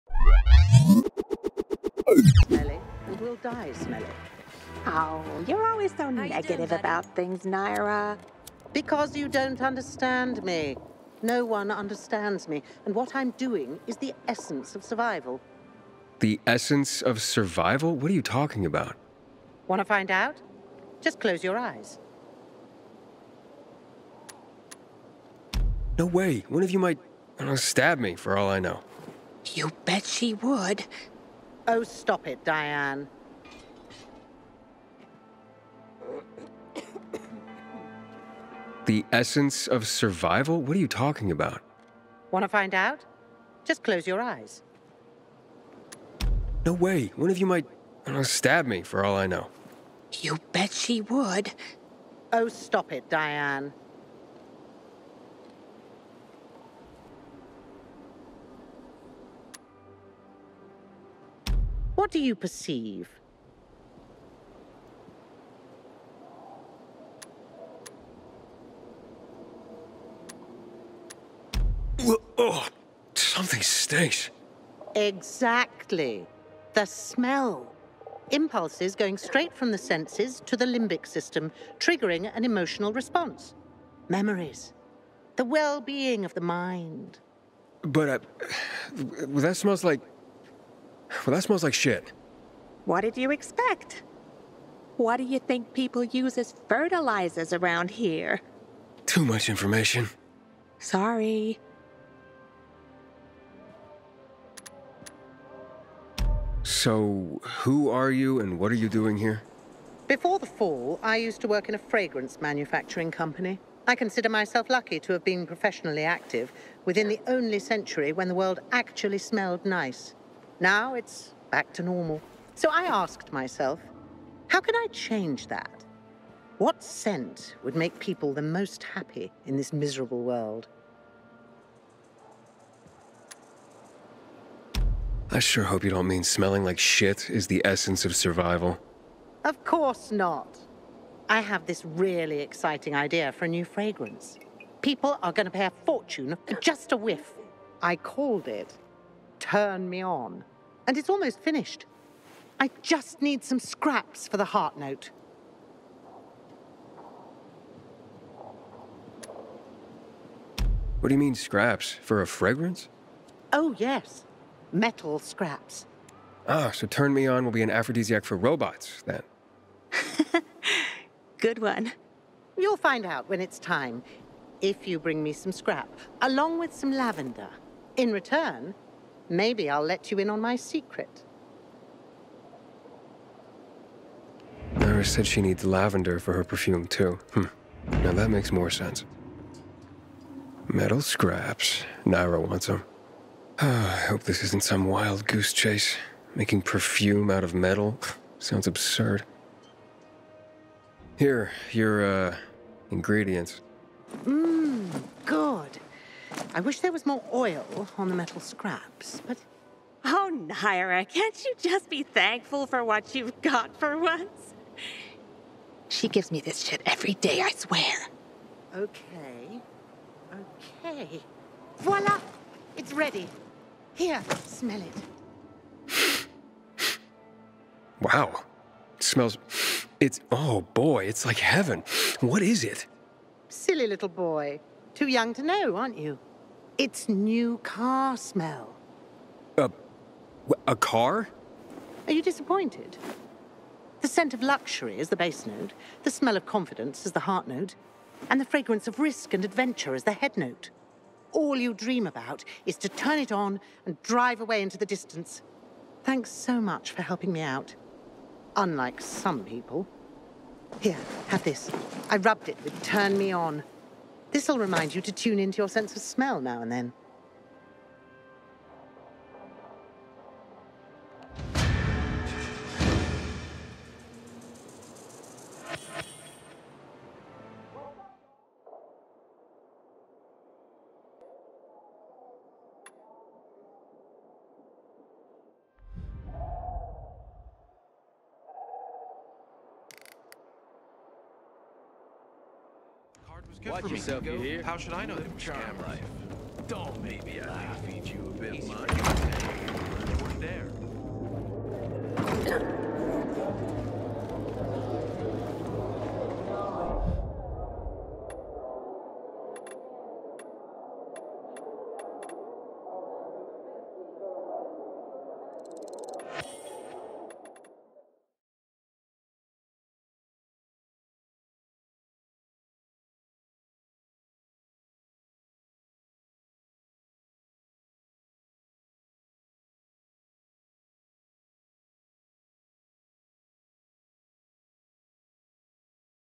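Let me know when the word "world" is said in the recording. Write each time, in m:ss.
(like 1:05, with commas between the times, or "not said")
1:58, 2:10.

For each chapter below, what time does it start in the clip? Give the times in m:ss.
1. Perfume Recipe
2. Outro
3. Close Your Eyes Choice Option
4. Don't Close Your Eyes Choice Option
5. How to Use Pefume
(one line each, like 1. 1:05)
1. 4:37
2. 5:16
3. 0:57
4. 0:20
5. 4:55.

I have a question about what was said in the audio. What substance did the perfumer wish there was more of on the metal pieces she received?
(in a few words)
Oil.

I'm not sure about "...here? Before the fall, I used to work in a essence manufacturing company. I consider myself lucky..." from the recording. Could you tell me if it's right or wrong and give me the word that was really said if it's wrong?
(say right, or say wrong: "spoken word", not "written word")
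wrong: "fragrance", not "essence".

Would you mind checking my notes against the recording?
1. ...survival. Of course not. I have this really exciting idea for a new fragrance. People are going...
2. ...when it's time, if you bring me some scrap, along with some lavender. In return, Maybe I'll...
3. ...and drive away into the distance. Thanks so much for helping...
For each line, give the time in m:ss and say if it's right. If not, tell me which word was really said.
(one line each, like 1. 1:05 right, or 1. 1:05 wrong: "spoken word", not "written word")
1. 2:18 right
2. 2:53 right
3. 4:13 right.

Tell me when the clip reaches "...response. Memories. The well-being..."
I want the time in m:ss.
1:22.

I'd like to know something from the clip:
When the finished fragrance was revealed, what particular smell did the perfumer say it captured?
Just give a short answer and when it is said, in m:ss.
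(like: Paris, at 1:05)
New car smell, at 3:56.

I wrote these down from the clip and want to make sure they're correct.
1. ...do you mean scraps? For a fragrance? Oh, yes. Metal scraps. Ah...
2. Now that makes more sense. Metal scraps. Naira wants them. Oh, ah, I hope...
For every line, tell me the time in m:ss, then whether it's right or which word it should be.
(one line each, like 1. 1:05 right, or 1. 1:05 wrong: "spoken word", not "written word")
1. 2:41 right
2. 3:08 right.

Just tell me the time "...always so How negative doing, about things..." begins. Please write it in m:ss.
0:05.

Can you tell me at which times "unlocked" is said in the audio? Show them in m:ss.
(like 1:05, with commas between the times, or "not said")
not said.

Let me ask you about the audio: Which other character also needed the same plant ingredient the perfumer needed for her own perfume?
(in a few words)
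Lara.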